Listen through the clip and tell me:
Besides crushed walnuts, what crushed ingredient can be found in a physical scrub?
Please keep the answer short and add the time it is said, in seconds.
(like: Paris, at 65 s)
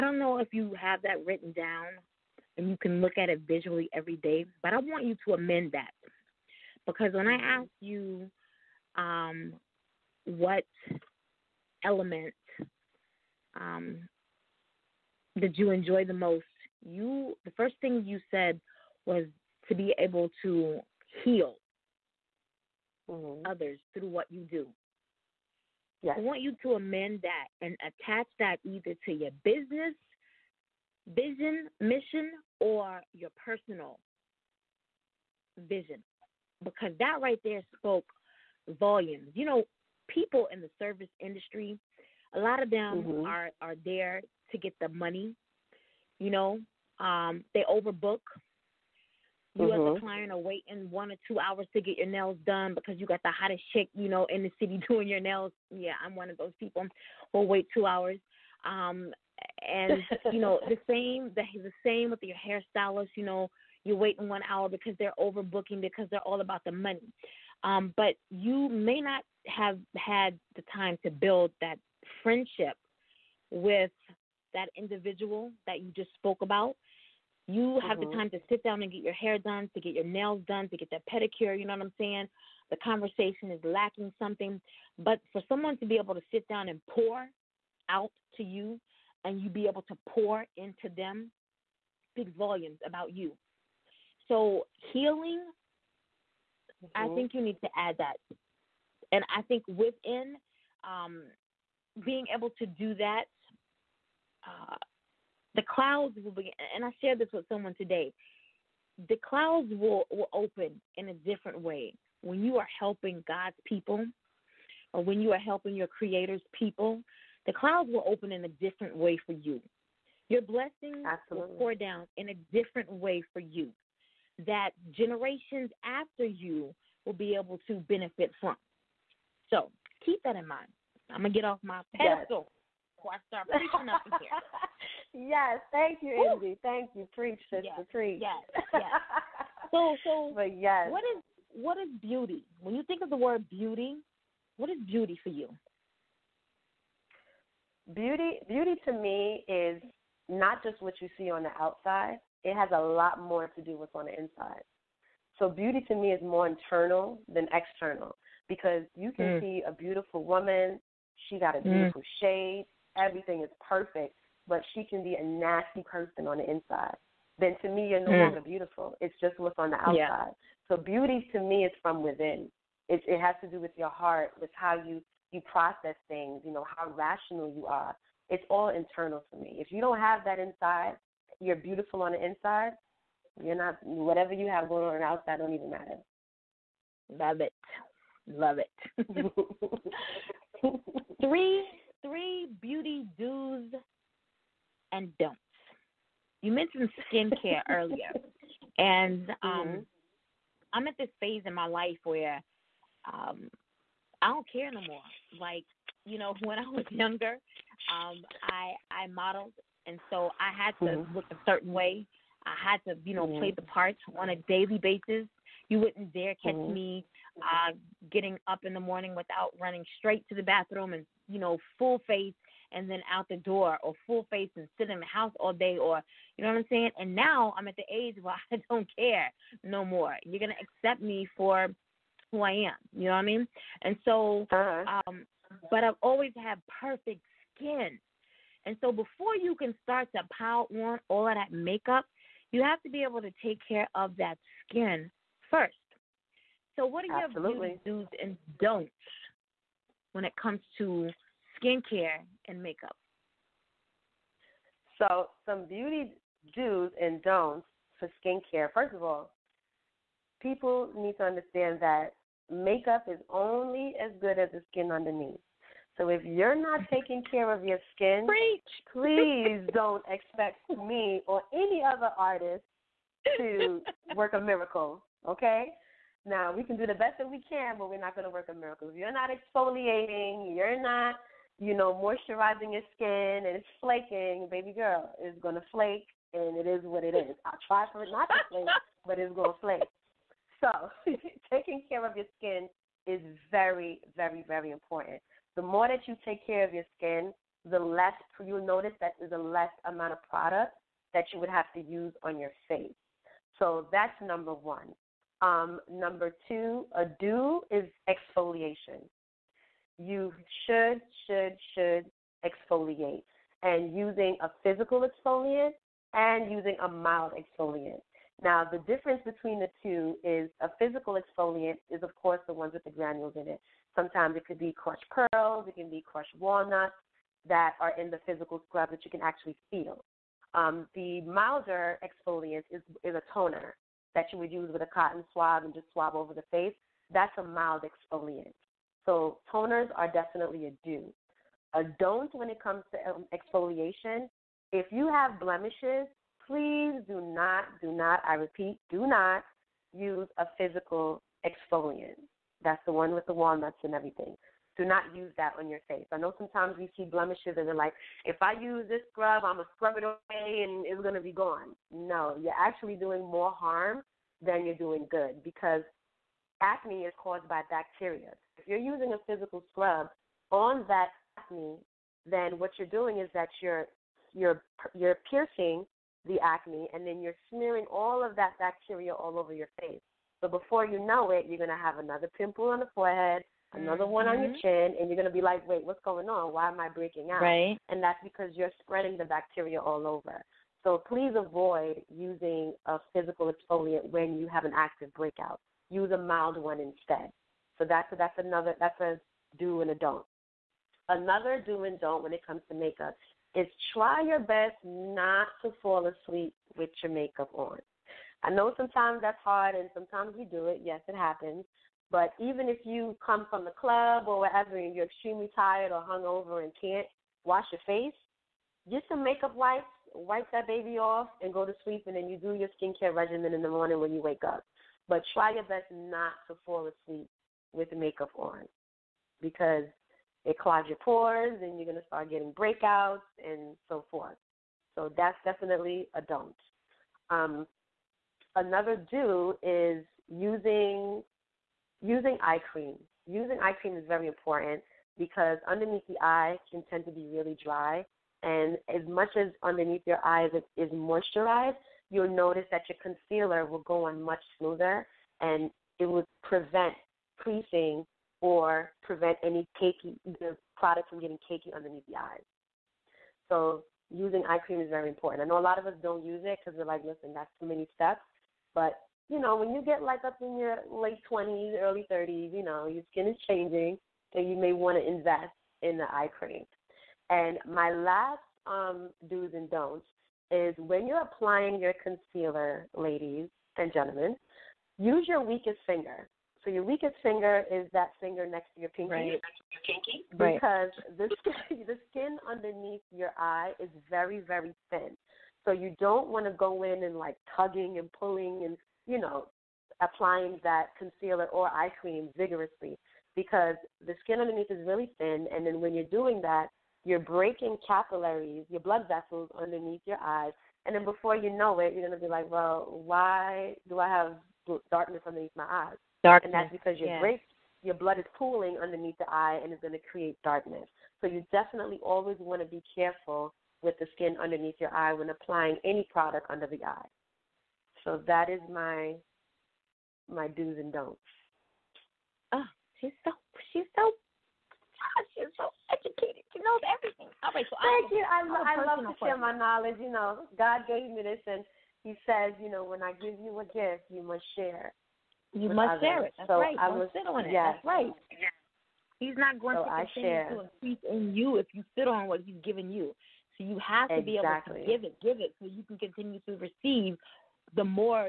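Crushed pearls, at 324 s.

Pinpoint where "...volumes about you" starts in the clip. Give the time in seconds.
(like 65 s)
92 s.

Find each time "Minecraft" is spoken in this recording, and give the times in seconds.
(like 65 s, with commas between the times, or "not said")
not said.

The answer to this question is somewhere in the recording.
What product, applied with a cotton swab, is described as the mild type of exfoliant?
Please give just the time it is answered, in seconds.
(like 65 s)
333 s.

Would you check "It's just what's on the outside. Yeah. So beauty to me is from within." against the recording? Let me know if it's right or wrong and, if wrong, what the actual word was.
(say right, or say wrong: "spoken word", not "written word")
right.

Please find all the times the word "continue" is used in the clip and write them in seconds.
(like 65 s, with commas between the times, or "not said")
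550 s, 555 s.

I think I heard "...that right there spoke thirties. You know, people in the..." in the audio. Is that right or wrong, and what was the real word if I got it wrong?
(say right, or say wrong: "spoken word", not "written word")
wrong: "volumes", not "thirties".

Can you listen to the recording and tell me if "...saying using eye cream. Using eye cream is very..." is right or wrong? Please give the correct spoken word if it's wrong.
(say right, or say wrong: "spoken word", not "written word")
wrong: "using", not "saying".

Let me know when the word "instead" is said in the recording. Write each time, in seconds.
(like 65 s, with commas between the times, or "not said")
396 s.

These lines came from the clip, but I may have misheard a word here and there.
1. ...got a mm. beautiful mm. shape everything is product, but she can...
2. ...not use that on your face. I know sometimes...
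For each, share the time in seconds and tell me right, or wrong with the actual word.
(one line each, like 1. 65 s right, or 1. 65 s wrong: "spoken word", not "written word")
1. 161 s wrong: "perfect", not "product"
2. 354 s right.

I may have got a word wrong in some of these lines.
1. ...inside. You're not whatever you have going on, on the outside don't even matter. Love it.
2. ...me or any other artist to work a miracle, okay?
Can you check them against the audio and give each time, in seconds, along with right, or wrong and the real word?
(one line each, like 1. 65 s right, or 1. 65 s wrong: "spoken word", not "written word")
1. 182 s right
2. 270 s right.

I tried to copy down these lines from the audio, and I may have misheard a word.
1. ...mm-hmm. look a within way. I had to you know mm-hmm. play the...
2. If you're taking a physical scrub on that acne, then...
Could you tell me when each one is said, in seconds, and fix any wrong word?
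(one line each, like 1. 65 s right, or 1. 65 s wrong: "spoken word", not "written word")
1. 210 s wrong: "certain", not "within"
2. 368 s wrong: "using", not "taking".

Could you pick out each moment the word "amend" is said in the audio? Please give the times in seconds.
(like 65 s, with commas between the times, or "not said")
5 s, 26 s.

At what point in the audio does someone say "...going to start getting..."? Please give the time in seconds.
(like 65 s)
431 s.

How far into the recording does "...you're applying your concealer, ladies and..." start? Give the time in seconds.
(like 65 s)
481 s.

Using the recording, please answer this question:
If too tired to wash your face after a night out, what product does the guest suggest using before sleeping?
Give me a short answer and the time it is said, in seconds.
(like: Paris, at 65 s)
Makeup wipes, at 419 s.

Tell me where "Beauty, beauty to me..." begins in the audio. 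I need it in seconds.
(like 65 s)
147 s.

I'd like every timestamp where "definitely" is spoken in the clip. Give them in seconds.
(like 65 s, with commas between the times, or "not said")
340 s, 435 s, 521 s.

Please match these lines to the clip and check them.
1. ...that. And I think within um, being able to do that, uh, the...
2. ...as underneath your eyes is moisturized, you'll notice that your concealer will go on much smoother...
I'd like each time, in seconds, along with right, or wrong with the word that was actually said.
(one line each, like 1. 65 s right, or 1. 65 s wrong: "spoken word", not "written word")
1. 97 s right
2. 449 s right.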